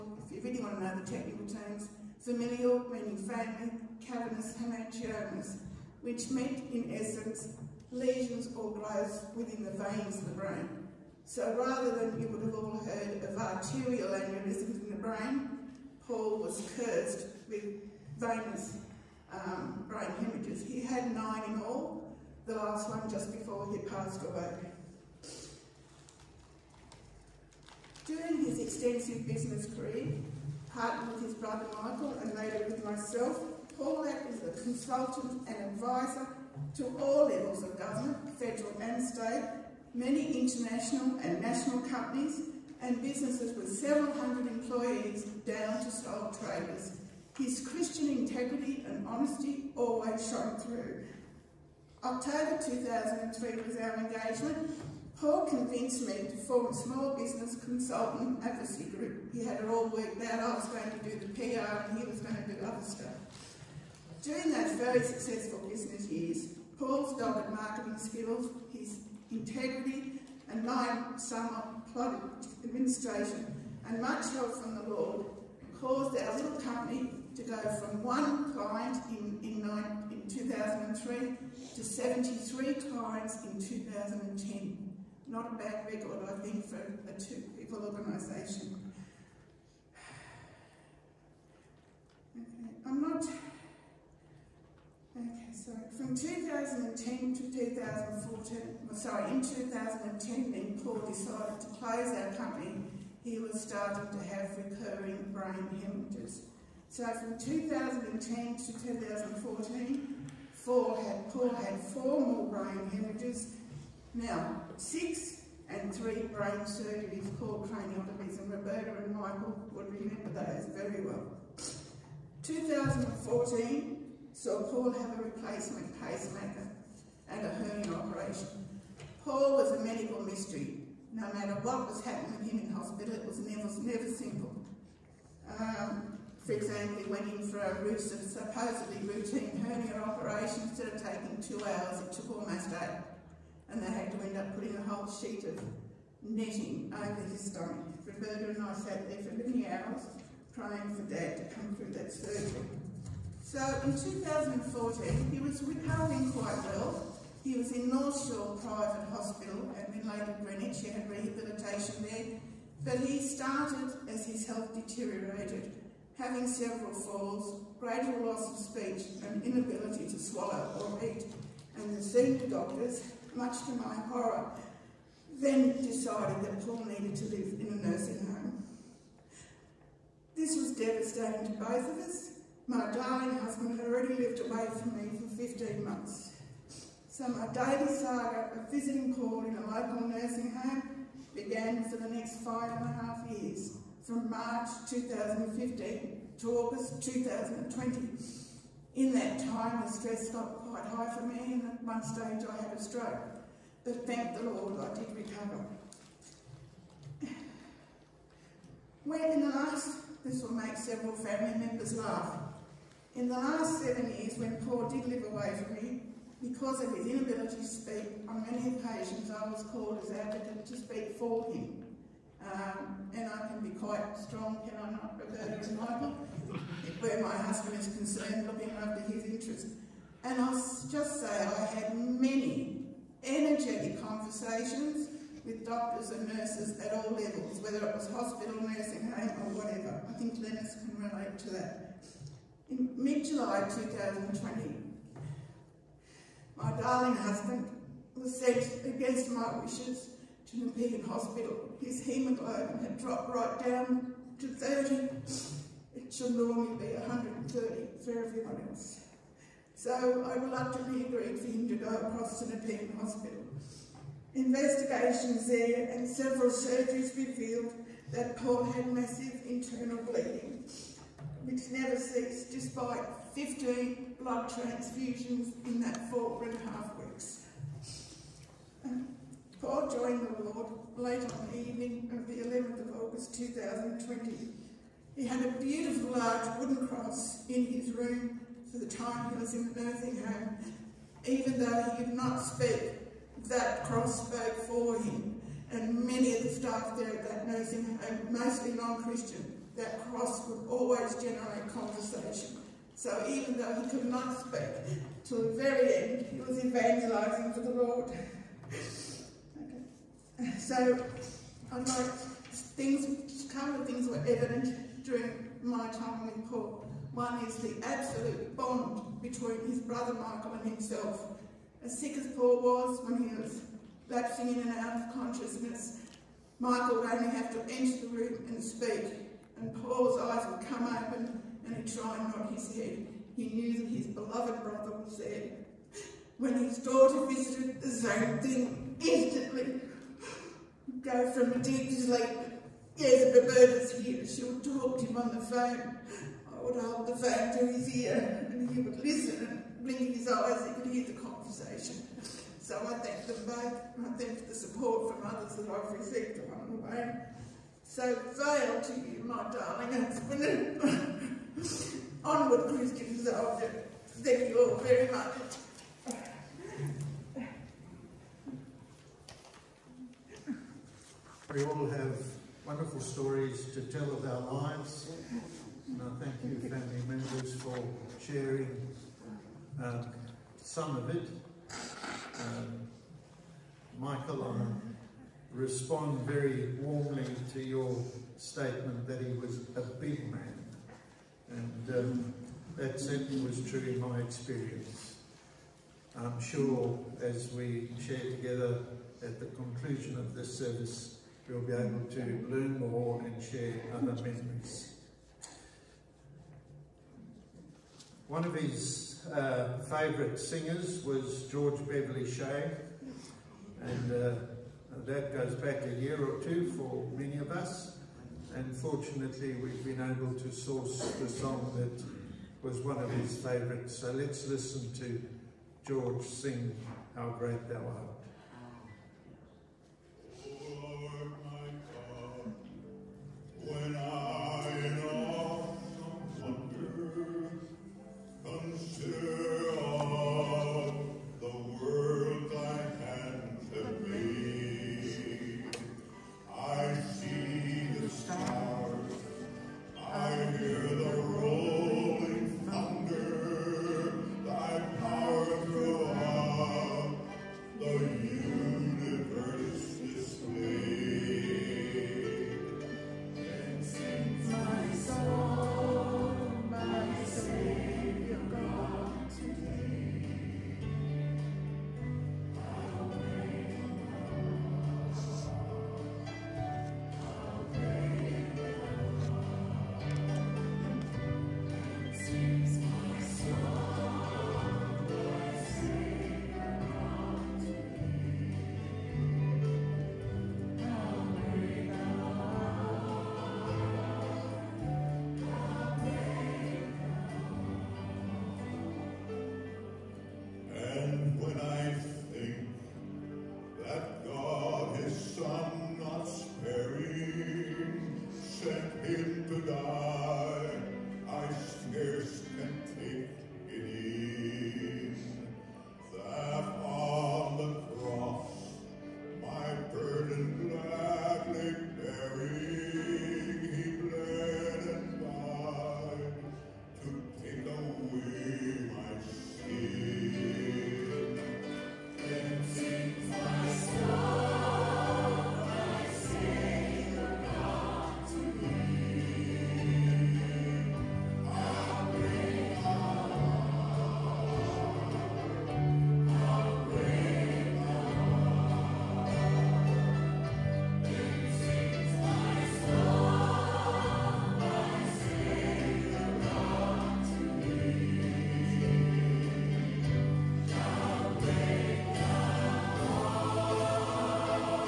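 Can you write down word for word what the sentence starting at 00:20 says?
He had nine in all, the last one just before he passed away.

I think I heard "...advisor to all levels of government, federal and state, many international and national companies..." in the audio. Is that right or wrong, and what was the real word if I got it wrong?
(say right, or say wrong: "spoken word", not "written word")
right.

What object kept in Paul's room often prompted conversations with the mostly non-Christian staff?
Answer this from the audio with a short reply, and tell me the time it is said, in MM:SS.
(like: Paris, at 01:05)
wooden cross, at 04:46.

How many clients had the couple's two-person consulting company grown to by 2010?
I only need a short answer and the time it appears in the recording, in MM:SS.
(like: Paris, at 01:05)
73, at 01:21.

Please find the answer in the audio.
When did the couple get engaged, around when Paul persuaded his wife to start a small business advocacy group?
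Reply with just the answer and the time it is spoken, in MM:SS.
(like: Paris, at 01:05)
October 2003, at 00:52.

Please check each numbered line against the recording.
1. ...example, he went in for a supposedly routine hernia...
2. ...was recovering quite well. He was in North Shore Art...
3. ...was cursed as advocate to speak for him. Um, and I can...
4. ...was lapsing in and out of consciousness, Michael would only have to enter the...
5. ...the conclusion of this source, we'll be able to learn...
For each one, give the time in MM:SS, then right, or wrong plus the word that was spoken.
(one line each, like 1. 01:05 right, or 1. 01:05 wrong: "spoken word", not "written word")
1. 02:16 right
2. 02:35 wrong: "Private", not "Art"
3. 03:39 wrong: "called", not "cursed"
4. 05:23 right
5. 06:39 wrong: "service", not "source".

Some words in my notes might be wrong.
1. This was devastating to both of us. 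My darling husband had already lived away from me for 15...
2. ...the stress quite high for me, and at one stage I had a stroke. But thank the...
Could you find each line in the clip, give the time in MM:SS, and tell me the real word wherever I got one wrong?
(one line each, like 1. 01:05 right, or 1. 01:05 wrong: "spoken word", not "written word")
1. 03:00 right
2. 03:19 right.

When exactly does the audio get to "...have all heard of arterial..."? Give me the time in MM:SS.
00:12.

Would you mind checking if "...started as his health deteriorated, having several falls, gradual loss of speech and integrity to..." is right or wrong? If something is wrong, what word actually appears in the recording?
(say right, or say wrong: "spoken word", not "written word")
wrong: "inability", not "integrity".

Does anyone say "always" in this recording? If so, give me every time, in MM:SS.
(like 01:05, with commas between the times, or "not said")
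00:49, 05:00.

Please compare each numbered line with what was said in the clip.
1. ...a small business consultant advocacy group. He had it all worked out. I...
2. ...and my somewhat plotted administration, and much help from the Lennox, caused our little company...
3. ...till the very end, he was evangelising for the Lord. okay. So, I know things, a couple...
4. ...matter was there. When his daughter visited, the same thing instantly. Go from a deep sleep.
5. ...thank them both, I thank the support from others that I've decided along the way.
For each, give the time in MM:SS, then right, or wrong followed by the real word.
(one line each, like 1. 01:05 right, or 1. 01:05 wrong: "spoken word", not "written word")
1. 00:56 right
2. 01:10 wrong: "Lord", not "Lennox"
3. 05:05 right
4. 05:34 wrong: "brother", not "matter"
5. 05:52 wrong: "received", not "decided".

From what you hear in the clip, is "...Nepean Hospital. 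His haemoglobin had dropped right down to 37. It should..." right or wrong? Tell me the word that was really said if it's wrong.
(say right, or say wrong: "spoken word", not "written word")
wrong: "30", not "37".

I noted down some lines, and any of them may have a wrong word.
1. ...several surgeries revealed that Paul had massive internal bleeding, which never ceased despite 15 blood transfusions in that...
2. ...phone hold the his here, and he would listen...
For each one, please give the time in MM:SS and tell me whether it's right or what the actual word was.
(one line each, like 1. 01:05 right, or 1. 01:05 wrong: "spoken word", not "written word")
1. 04:26 right
2. 05:45 right.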